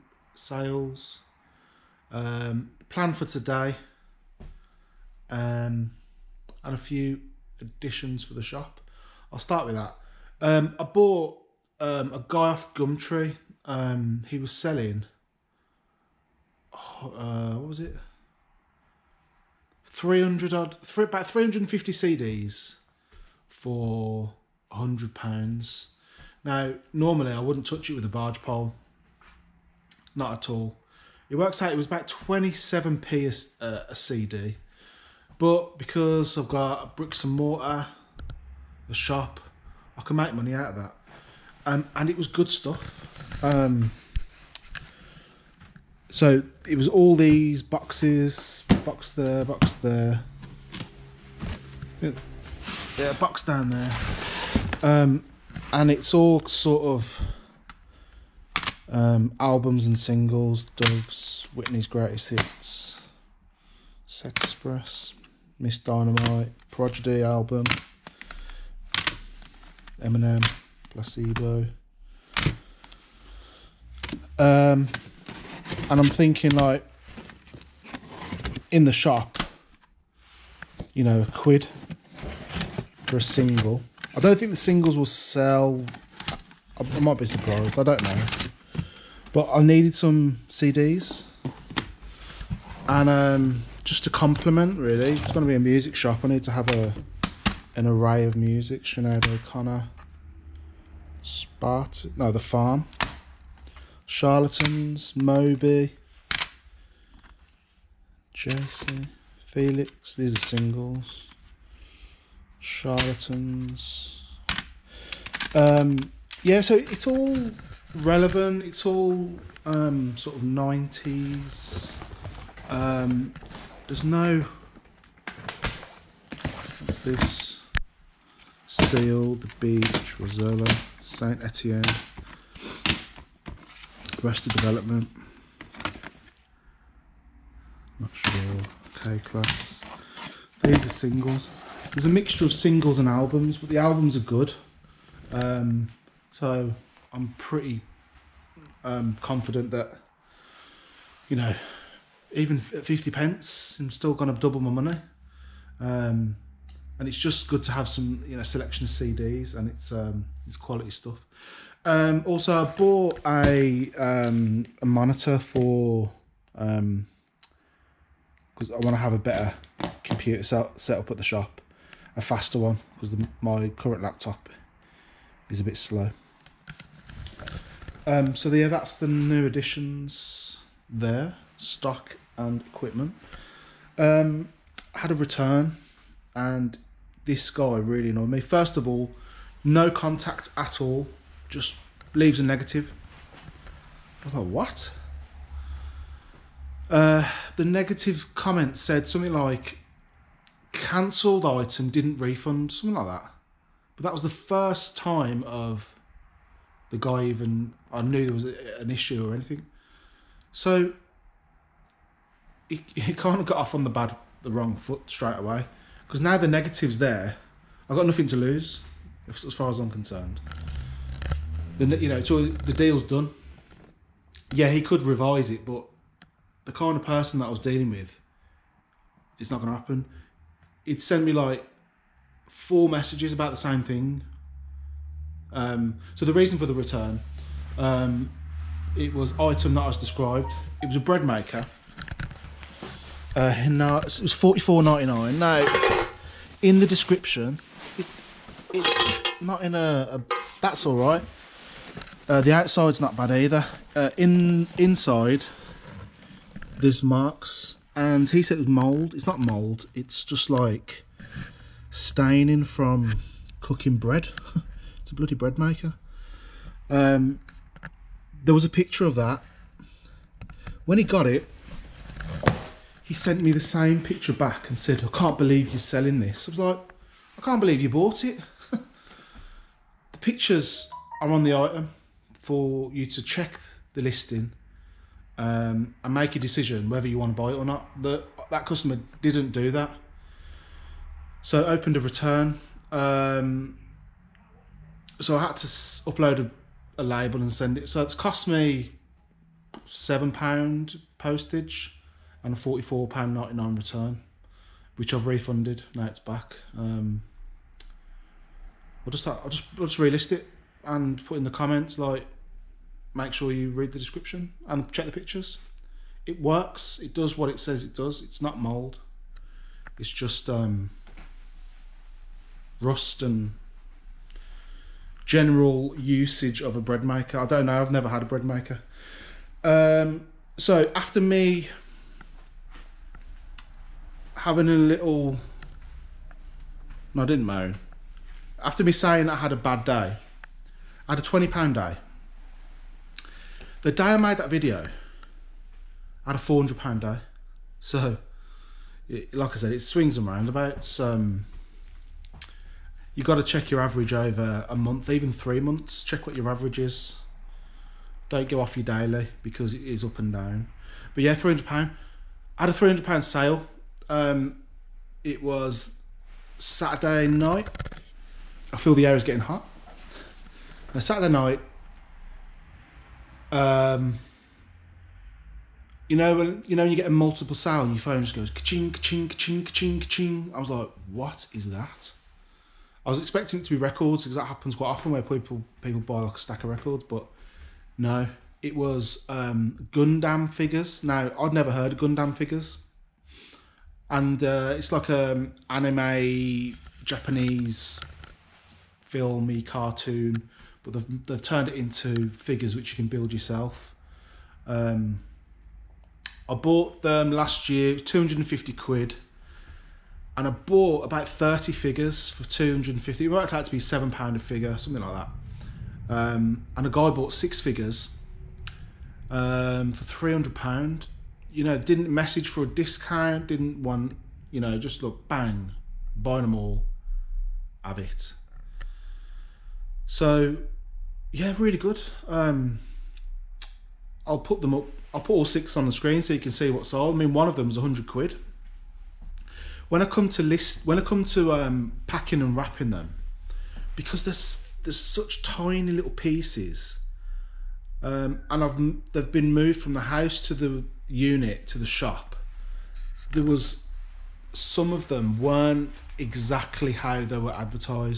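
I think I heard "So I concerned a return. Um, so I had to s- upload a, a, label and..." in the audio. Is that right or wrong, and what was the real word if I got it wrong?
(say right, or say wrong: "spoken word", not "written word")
wrong: "opened", not "concerned".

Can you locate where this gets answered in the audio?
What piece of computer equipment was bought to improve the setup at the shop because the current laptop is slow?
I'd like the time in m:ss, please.
2:44.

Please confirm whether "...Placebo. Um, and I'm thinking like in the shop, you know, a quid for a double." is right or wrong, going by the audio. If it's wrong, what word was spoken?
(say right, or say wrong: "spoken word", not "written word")
wrong: "single", not "double".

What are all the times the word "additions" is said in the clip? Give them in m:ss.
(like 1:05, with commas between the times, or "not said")
0:07, 2:59.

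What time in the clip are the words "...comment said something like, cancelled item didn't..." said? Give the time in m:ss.
3:18.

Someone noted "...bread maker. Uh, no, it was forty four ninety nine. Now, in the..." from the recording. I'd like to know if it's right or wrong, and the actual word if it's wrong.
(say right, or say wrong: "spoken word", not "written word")
right.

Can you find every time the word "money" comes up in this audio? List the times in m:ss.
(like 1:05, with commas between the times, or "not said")
0:40, 2:34.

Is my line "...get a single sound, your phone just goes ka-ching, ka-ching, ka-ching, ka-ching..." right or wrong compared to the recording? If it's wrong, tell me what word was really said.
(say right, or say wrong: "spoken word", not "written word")
wrong: "multiple", not "single".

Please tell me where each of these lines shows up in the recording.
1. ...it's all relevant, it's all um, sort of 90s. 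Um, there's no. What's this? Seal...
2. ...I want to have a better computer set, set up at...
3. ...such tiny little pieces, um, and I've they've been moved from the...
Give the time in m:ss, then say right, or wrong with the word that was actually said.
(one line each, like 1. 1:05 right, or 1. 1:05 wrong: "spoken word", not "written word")
1. 1:56 right
2. 2:48 right
3. 7:24 right.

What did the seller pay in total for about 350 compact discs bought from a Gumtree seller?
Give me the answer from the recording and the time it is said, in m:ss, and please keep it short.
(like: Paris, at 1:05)
£100, at 0:24.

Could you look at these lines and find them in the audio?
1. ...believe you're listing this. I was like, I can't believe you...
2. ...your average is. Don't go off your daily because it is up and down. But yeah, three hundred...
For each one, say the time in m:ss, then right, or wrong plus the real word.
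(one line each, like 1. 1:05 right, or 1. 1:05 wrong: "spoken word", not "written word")
1. 4:35 wrong: "selling", not "listing"
2. 5:56 right.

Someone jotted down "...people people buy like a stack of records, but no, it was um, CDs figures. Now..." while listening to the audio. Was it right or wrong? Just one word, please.
wrong.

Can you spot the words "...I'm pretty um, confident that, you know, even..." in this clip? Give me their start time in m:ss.
2:27.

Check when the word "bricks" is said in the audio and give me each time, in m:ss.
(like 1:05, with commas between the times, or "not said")
0:36.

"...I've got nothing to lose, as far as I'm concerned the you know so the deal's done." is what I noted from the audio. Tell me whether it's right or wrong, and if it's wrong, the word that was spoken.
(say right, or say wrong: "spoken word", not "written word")
right.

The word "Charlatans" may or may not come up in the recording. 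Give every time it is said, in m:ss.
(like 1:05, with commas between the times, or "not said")
1:44, 1:52.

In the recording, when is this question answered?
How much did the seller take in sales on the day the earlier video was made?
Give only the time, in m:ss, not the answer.
5:46.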